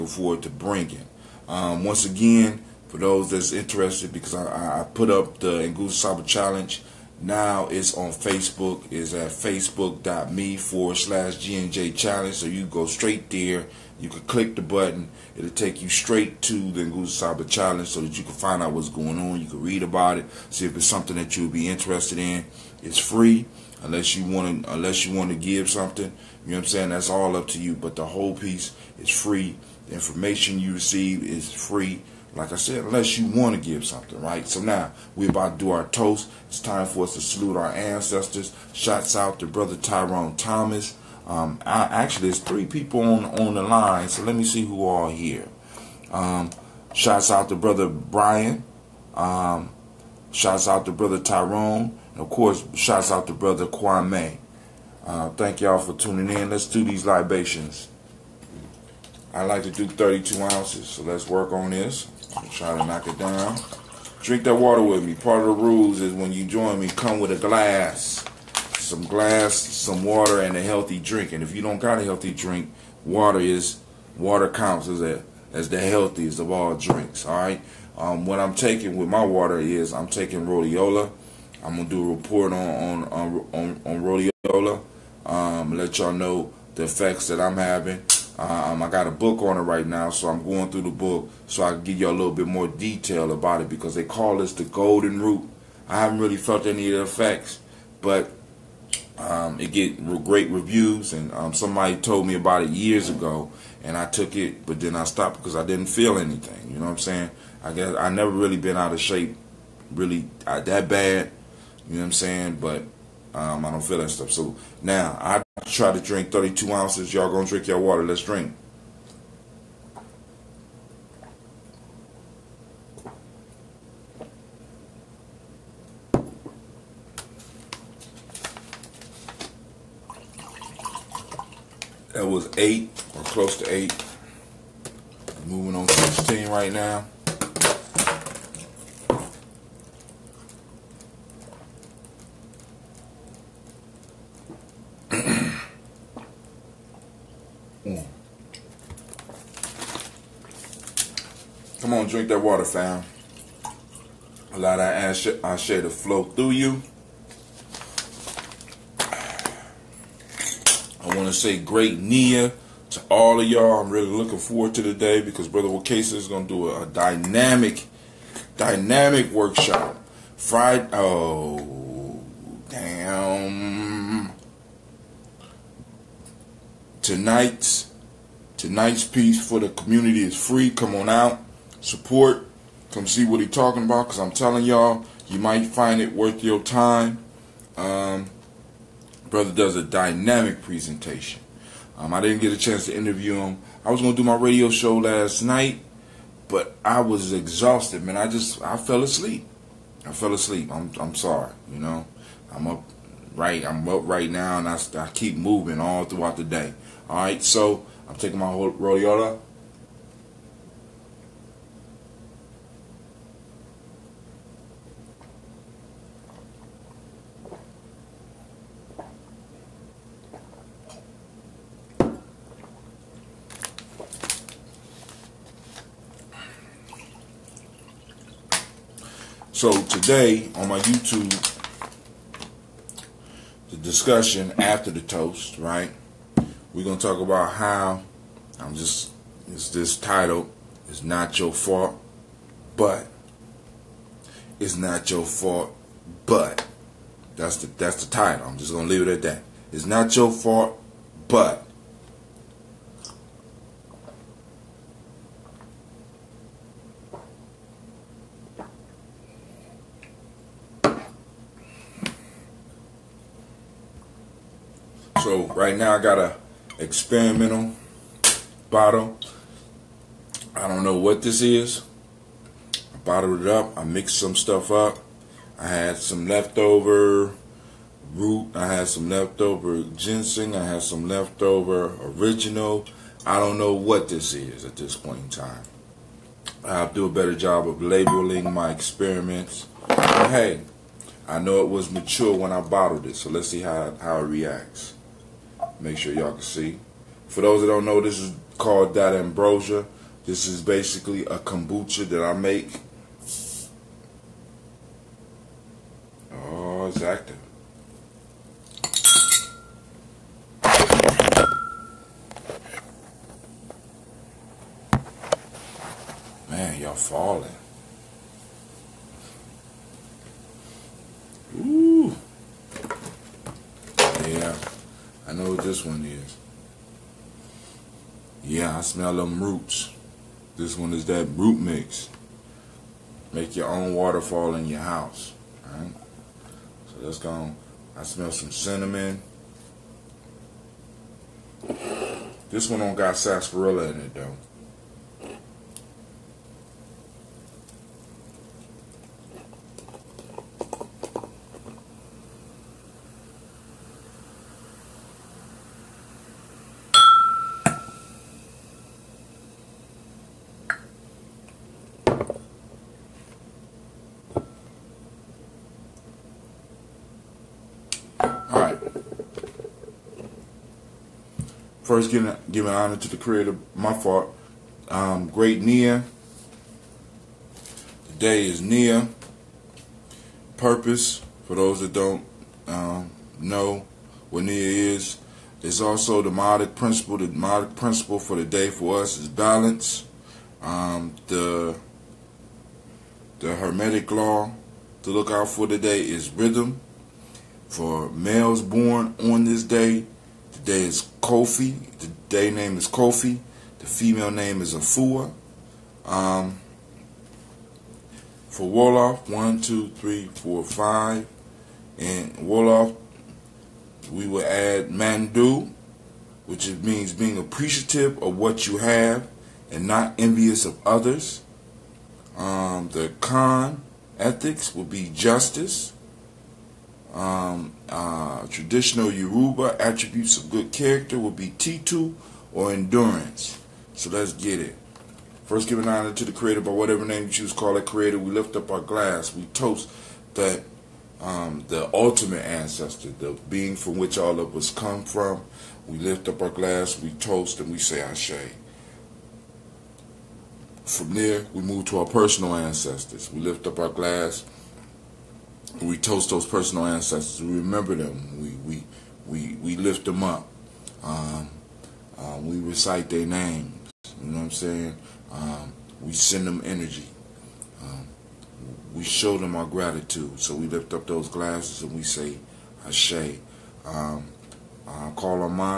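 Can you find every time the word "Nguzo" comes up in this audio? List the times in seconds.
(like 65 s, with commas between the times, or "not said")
5 s, 16 s.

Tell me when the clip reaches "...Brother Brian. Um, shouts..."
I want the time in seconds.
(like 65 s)
47 s.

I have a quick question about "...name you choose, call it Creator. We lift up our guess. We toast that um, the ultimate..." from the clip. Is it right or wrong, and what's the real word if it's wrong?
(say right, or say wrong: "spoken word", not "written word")
wrong: "glass", not "guess".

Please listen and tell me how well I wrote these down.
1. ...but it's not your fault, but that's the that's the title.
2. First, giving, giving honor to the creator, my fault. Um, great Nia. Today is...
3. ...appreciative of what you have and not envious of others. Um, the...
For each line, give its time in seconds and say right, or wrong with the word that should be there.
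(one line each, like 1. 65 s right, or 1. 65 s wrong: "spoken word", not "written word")
1. 242 s right
2. 371 s right
3. 417 s right.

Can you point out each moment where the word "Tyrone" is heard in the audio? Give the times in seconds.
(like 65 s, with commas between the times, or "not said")
39 s, 51 s.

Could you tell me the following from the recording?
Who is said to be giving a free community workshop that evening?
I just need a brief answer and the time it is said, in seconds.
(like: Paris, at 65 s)
Brother Wakasa, at 165 s.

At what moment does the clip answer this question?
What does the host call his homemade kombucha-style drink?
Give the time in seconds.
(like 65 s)
299 s.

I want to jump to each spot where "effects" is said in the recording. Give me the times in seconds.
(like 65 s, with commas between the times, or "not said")
86 s, 97 s.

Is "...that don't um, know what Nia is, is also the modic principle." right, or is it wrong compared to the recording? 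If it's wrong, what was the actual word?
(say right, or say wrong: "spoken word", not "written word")
right.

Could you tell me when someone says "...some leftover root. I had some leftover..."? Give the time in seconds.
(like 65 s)
275 s.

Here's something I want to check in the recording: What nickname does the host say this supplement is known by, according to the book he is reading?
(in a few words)
the golden root.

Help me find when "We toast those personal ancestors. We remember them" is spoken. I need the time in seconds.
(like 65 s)
455 s.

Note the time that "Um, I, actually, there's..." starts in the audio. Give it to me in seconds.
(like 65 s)
41 s.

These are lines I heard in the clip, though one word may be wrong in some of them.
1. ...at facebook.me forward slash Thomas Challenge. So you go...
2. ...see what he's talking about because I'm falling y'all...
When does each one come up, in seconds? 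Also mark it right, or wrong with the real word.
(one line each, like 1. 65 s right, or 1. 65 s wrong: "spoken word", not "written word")
1. 9 s wrong: "GNJ", not "Thomas"
2. 183 s wrong: "telling", not "falling".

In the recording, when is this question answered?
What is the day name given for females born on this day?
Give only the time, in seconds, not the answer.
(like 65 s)
404 s.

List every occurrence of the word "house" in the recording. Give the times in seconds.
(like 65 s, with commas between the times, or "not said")
334 s.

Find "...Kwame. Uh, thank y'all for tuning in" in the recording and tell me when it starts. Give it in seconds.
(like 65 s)
53 s.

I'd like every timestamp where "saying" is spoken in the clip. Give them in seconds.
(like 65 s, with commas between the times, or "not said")
26 s, 106 s, 112 s, 464 s.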